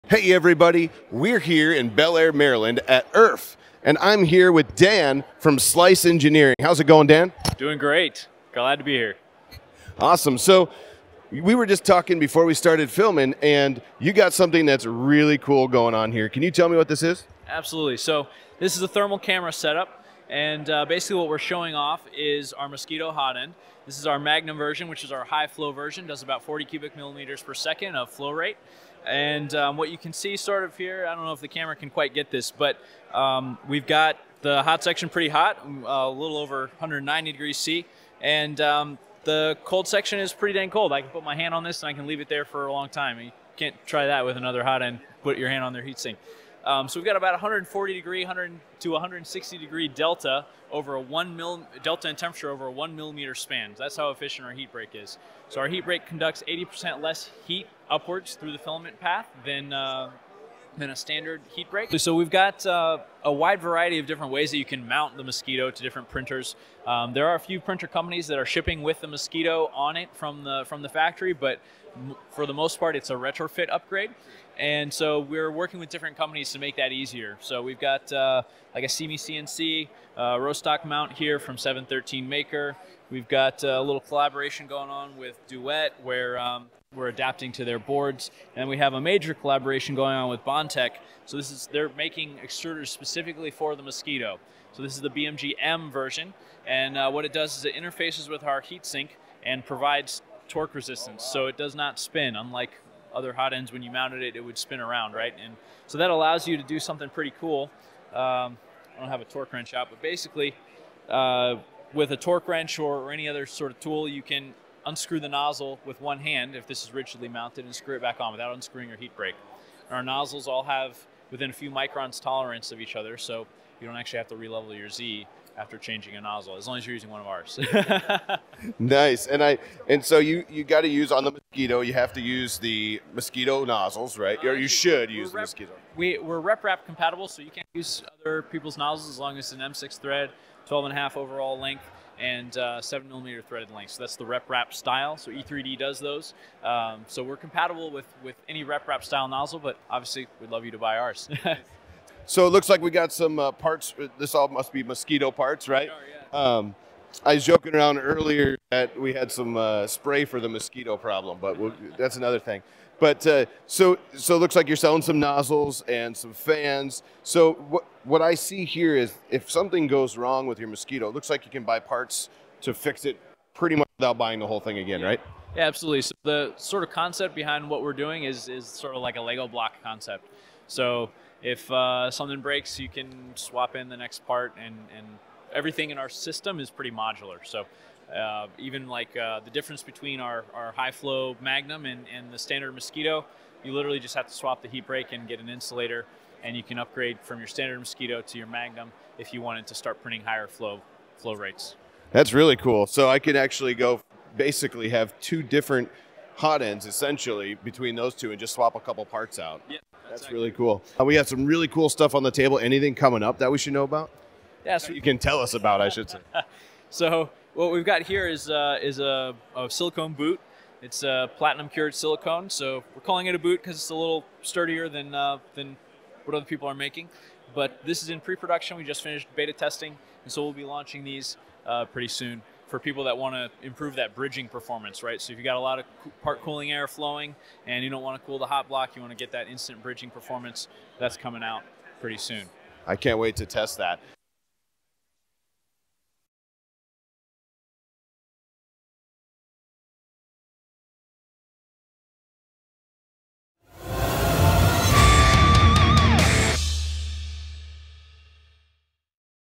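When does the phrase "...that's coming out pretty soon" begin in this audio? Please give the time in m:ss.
4:00.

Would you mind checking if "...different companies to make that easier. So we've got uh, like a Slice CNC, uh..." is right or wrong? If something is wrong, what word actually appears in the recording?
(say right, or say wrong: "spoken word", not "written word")
wrong: "CME", not "Slice".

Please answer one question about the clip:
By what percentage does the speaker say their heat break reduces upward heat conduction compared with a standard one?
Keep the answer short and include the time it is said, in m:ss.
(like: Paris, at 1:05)
80%, at 0:56.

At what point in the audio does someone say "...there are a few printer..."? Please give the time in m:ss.
1:07.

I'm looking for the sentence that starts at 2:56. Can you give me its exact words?
So the sort of concept behind what we're doing is is sort of like a Lego block concept.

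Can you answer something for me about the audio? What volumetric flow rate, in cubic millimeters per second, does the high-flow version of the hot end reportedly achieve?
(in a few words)
40.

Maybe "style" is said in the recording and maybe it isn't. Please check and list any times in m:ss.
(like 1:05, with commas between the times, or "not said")
2:24, 2:29.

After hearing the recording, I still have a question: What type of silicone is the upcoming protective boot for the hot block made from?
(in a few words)
platinum cured.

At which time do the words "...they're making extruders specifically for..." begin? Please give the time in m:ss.
1:31.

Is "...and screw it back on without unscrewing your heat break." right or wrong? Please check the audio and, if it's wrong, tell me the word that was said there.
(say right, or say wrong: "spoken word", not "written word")
right.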